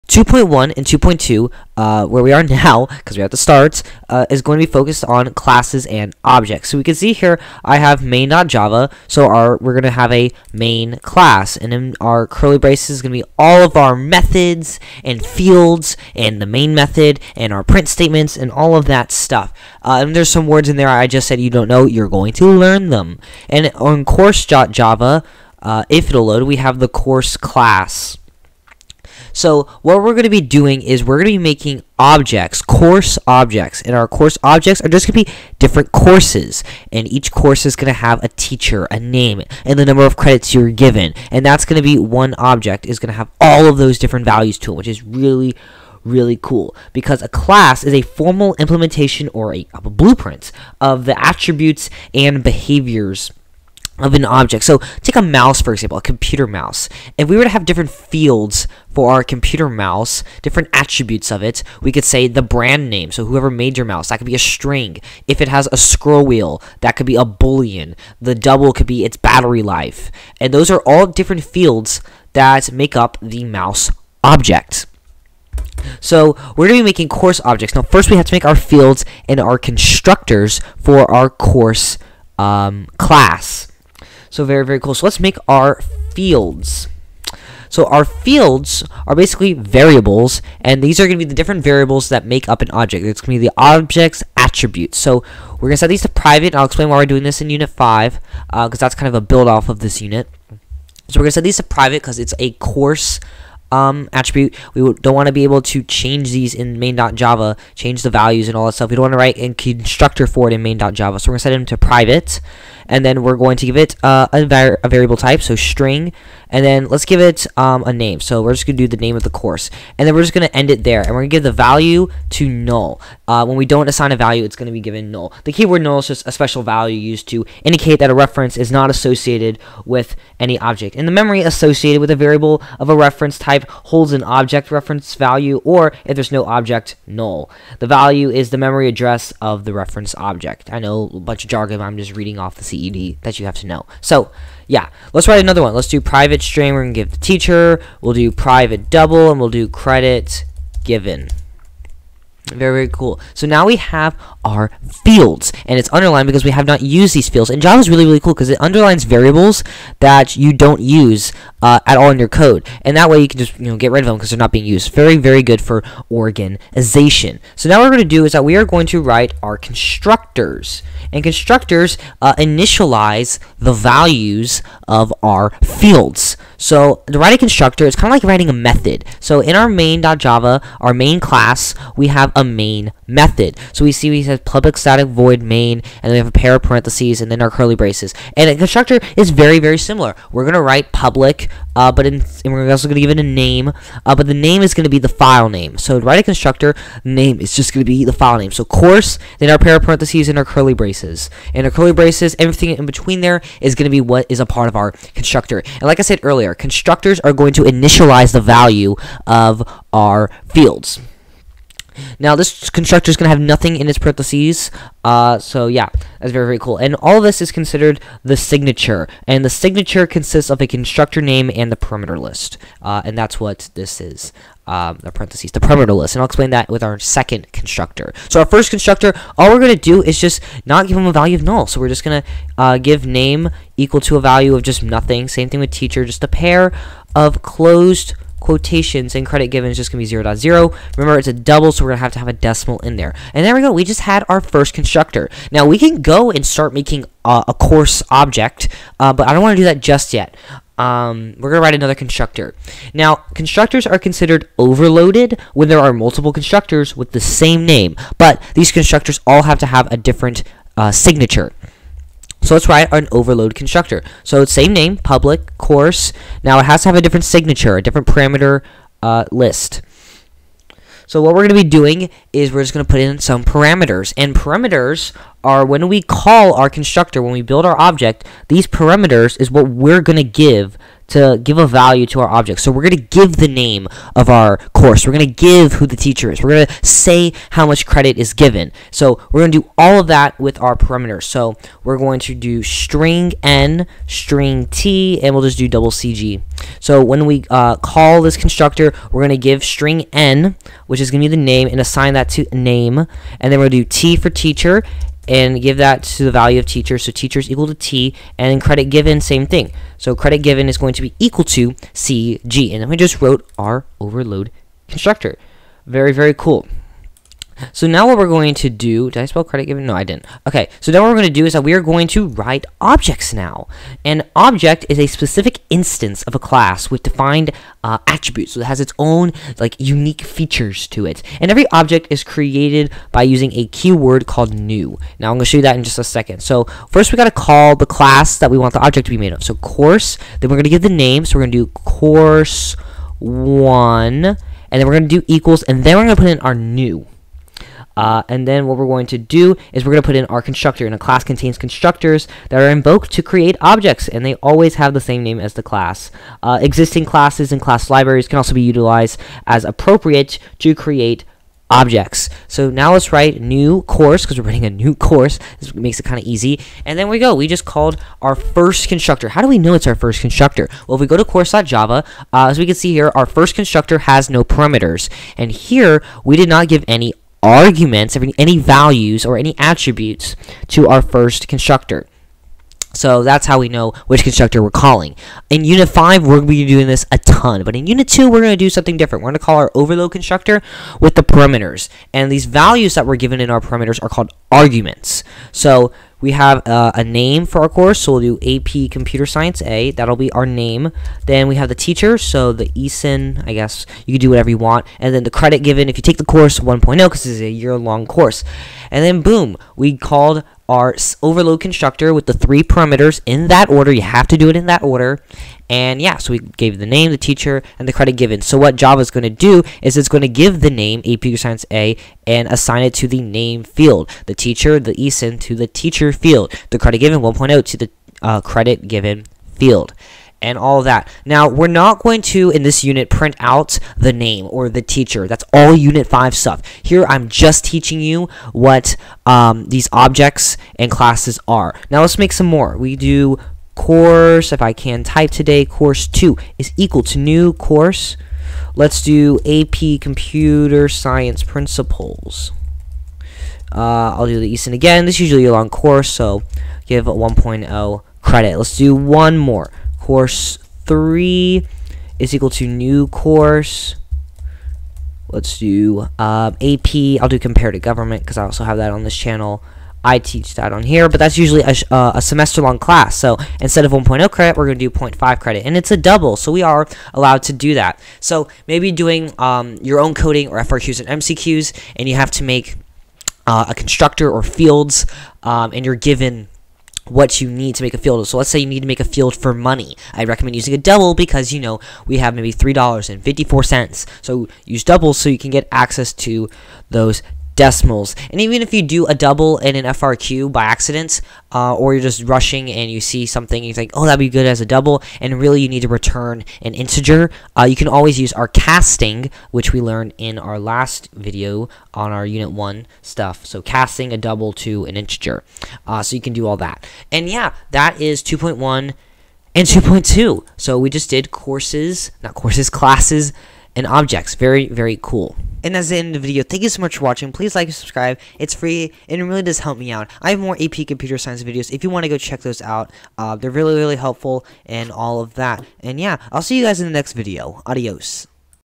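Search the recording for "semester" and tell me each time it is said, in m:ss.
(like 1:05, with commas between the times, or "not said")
7:52.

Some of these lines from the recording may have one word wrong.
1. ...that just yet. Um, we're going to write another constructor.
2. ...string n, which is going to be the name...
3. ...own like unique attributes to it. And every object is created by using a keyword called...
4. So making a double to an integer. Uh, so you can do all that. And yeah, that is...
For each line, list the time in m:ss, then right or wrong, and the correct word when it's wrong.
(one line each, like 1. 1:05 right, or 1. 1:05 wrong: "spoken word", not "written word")
1. 4:09 right
2. 4:59 right
3. 5:28 wrong: "features", not "attributes"
4. 8:33 wrong: "casting", not "making".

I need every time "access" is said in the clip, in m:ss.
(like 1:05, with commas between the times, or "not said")
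8:15.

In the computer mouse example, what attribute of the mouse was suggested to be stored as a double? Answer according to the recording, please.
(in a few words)
battery life.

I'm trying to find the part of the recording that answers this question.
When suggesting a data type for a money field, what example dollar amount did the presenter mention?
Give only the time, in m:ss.
8:12.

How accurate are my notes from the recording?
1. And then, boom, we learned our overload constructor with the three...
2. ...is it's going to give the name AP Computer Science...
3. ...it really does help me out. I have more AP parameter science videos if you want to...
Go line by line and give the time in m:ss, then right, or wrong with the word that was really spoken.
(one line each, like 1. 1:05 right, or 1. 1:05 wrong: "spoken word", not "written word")
1. 6:48 wrong: "called", not "learned"
2. 6:59 right
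3. 8:49 wrong: "computer", not "parameter".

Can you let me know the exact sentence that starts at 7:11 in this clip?
Now, we're not going to, in this unit, print out the name or the teacher.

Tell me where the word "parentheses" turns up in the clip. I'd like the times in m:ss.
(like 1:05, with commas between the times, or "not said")
3:06, 3:19, 3:33, 3:45.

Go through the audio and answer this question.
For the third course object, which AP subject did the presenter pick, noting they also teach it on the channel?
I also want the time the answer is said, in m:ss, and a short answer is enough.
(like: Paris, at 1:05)
comparative government, at 7:47.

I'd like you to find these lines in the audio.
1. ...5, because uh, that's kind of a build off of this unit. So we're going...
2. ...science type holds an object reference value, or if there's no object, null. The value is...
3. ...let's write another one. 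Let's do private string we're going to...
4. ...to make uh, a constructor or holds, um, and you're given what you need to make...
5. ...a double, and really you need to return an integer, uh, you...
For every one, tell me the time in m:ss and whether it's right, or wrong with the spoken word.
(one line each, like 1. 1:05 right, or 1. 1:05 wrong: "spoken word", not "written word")
1. 1:37 right
2. 2:12 wrong: "reference", not "science"
3. 2:25 right
4. 8:02 wrong: "fields", not "holds"
5. 8:24 right.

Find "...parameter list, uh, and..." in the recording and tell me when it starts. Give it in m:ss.
3:41.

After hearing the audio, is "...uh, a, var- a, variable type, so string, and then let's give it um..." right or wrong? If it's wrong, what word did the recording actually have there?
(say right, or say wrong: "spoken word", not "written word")
right.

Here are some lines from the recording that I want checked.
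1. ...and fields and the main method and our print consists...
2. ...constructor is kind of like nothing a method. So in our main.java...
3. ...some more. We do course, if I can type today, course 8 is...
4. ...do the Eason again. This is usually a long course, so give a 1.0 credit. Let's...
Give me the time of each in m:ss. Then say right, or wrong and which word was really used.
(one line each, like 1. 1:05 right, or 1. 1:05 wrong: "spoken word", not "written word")
1. 0:15 wrong: "statements", not "consists"
2. 2:57 wrong: "writing", not "nothing"
3. 7:22 wrong: "2", not "8"
4. 7:34 right.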